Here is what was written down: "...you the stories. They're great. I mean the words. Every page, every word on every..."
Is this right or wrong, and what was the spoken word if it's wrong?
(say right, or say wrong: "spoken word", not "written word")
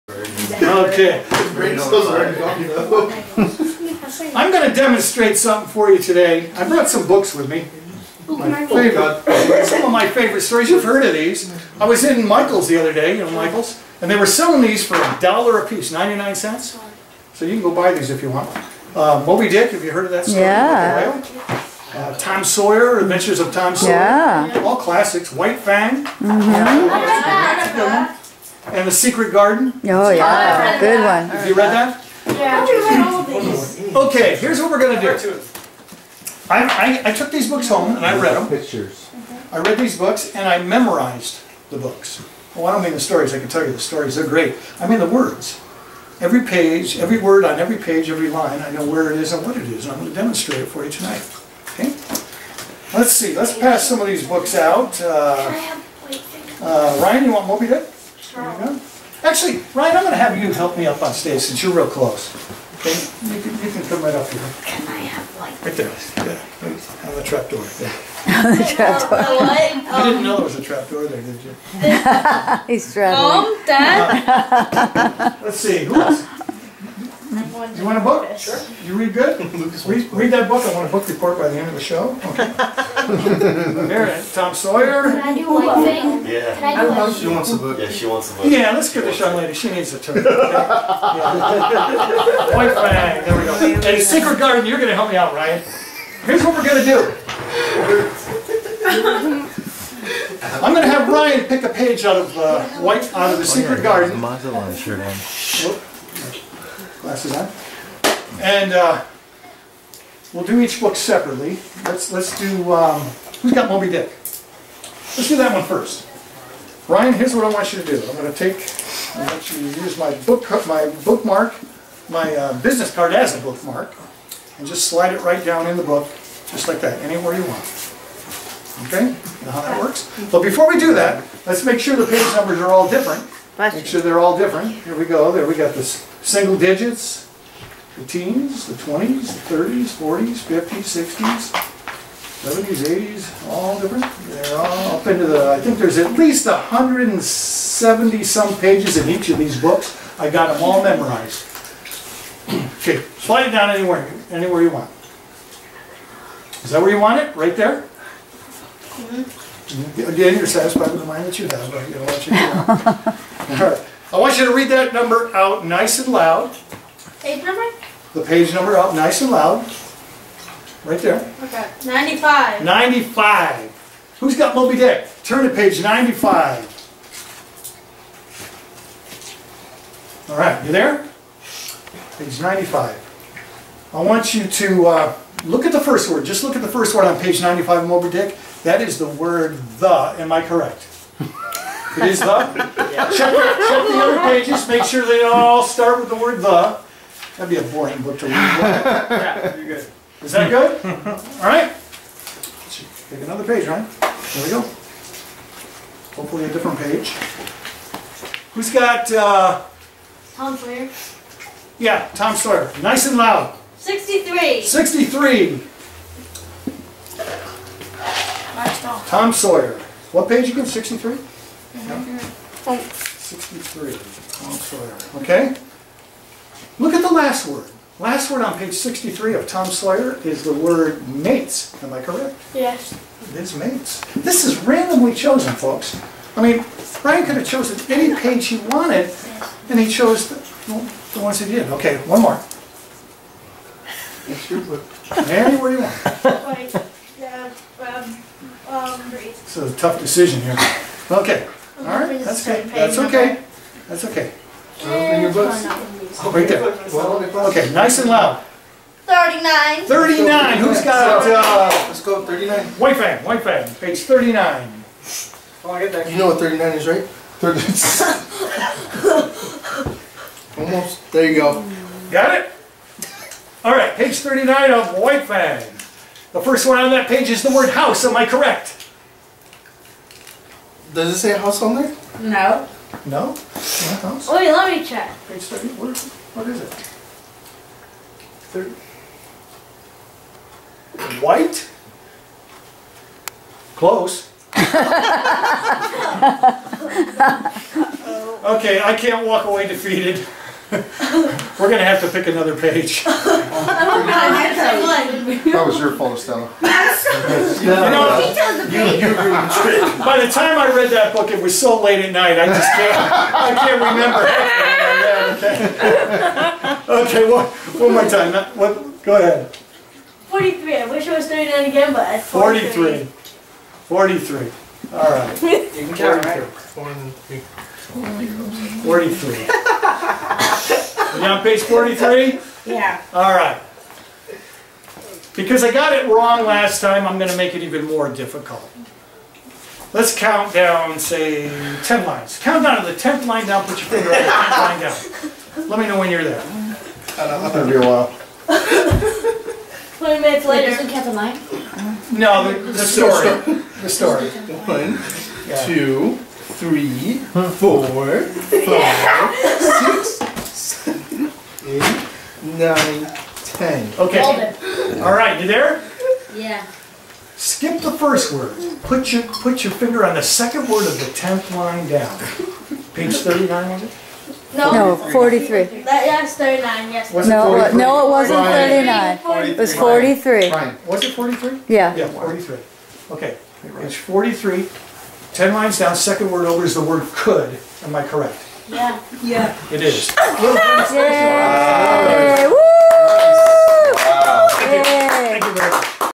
right.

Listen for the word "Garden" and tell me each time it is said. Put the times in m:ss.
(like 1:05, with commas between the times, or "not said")
0:29, 1:34, 1:43.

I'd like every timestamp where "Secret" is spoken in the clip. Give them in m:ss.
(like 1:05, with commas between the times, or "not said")
0:28, 1:33, 1:43.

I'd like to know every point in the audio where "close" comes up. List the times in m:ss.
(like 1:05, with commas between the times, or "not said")
1:01, 4:53.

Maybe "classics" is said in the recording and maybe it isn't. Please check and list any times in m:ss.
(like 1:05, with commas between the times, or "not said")
0:24.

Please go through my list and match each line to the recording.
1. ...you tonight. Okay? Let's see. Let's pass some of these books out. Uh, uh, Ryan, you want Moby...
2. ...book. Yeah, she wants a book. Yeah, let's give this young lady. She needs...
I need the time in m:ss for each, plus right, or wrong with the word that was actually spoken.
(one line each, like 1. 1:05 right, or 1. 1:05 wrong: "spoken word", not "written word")
1. 0:50 right
2. 1:27 right.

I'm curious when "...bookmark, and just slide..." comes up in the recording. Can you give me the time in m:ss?
2:03.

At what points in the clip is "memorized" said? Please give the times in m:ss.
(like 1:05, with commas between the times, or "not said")
0:40, 2:30.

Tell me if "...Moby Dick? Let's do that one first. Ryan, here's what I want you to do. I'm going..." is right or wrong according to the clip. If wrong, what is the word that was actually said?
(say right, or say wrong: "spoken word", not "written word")
right.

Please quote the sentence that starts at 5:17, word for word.
Okay, Okay, one, one more time, what, go ahead.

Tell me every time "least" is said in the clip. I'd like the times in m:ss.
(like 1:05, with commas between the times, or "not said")
2:26.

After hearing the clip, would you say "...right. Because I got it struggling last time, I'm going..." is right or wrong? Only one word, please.
wrong.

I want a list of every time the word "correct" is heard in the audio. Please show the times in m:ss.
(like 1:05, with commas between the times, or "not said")
3:10, 3:52, 4:38, 6:28.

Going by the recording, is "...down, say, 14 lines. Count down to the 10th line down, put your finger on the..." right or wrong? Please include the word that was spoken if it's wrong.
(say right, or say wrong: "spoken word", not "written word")
wrong: "10", not "14".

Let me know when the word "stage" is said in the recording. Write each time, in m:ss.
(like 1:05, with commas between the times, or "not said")
1:01.